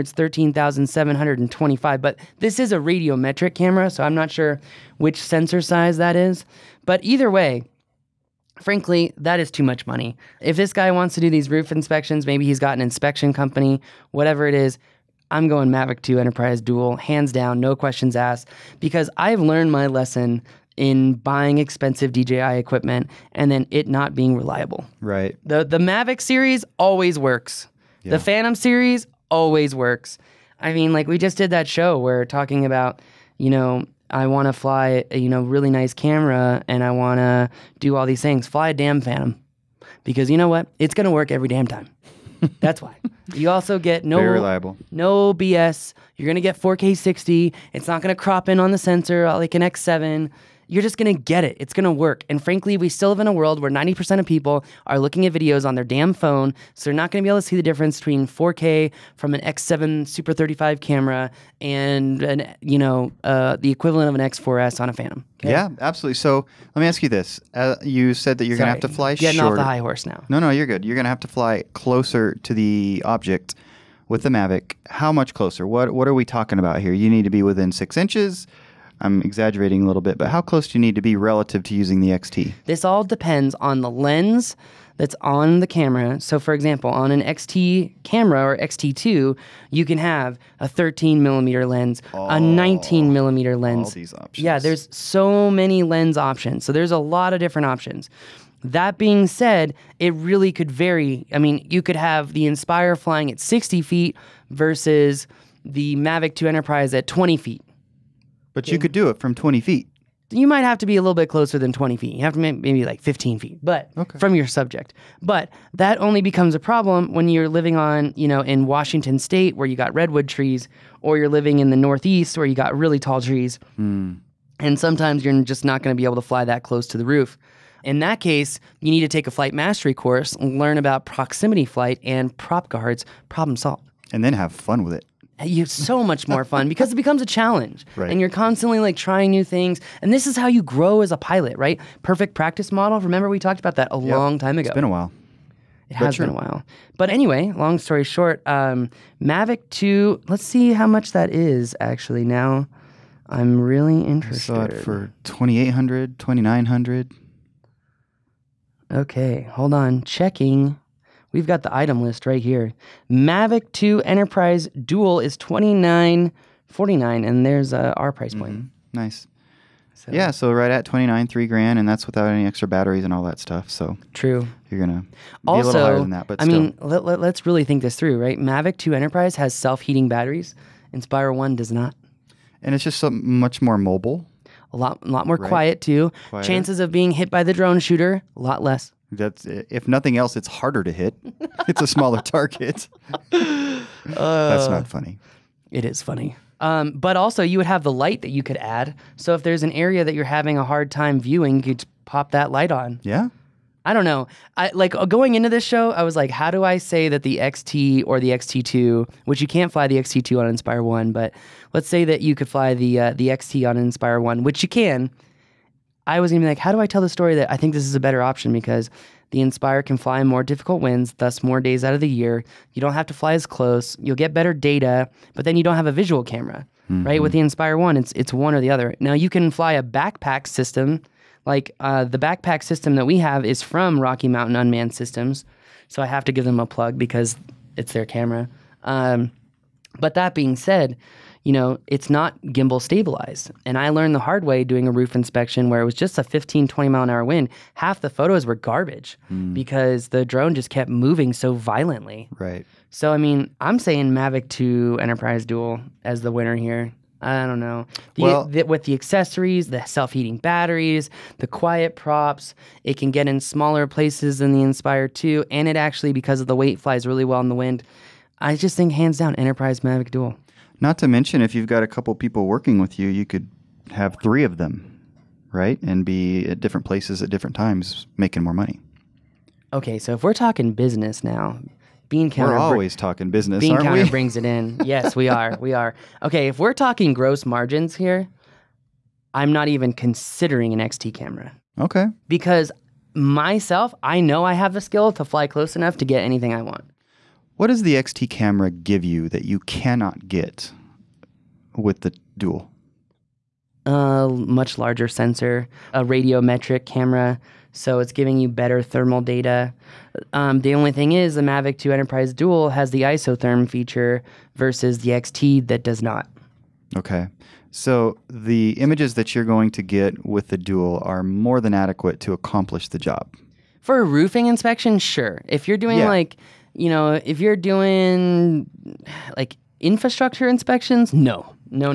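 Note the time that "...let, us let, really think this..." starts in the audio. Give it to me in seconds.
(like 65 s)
176 s.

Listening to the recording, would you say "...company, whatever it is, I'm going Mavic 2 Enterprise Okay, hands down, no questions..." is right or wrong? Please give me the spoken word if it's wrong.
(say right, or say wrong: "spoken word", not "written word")
wrong: "Dual", not "Okay".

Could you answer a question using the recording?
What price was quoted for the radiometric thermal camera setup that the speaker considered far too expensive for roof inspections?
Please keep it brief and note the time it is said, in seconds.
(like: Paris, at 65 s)
13,725, at 0 s.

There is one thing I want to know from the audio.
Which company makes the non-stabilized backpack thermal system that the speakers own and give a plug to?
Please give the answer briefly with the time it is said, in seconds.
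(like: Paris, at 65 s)
Rocky Mountain Unmanned Systems, at 234 s.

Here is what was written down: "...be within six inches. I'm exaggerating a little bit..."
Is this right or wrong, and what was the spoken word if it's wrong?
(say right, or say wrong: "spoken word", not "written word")
right.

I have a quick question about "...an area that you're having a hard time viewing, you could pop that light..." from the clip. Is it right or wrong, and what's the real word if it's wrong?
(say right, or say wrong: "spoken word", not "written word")
right.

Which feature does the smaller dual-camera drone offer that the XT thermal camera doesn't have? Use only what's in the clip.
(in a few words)
Isotherm.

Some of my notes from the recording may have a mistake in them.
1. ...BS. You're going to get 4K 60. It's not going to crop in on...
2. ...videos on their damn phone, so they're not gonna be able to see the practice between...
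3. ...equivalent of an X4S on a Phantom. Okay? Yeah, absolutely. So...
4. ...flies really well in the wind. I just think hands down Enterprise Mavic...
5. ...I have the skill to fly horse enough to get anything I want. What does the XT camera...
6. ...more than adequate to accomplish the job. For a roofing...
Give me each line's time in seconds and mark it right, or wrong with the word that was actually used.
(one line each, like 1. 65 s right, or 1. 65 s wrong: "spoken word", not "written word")
1. 45 s right
2. 55 s wrong: "difference", not "practice"
3. 63 s right
4. 266 s right
5. 294 s wrong: "close", not "horse"
6. 321 s right.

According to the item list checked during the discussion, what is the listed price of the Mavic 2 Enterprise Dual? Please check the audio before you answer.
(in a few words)
2,949.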